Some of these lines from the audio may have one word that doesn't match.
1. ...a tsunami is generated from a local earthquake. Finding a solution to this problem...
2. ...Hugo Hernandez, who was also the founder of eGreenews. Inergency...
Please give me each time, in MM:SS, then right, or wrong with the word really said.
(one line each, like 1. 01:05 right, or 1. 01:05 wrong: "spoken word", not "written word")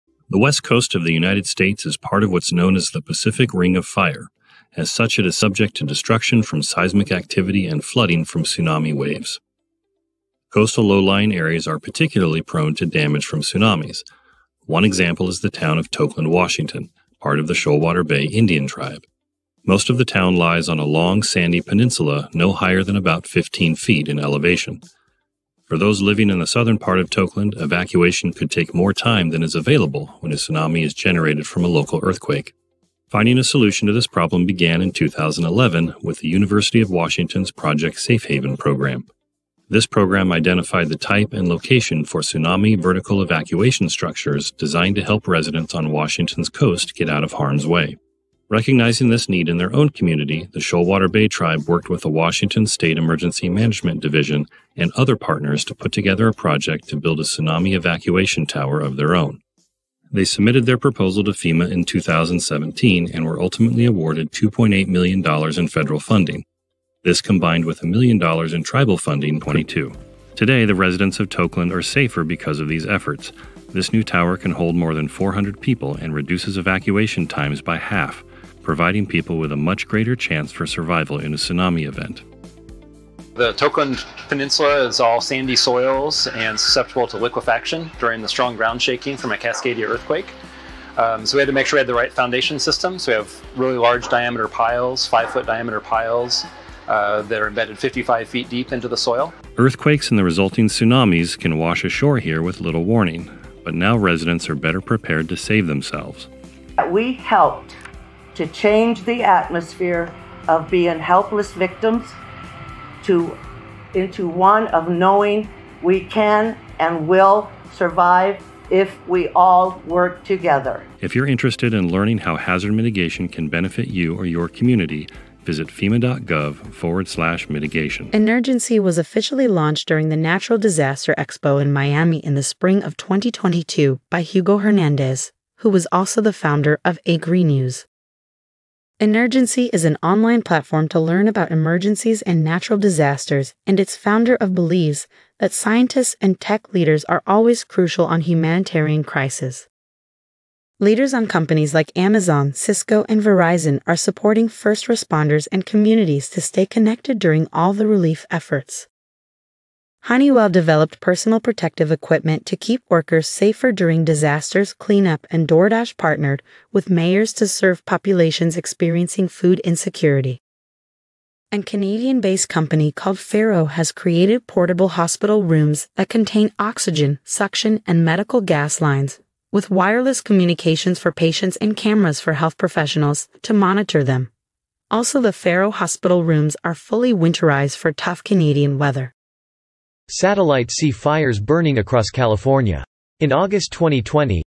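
1. 00:30 right
2. 02:14 right.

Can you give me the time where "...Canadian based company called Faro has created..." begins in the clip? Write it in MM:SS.
02:51.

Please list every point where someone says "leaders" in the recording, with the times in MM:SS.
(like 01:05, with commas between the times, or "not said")
02:26, 02:30.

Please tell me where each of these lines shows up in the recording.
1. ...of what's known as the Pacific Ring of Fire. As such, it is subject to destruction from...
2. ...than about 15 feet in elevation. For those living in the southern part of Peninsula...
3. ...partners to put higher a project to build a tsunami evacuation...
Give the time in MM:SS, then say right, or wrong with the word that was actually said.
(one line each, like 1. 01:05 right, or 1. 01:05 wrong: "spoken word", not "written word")
1. 00:02 right
2. 00:22 wrong: "Tokeland", not "Peninsula"
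3. 00:55 wrong: "together", not "higher".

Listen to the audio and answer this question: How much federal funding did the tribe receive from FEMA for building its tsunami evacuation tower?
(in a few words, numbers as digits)
$2.8 million.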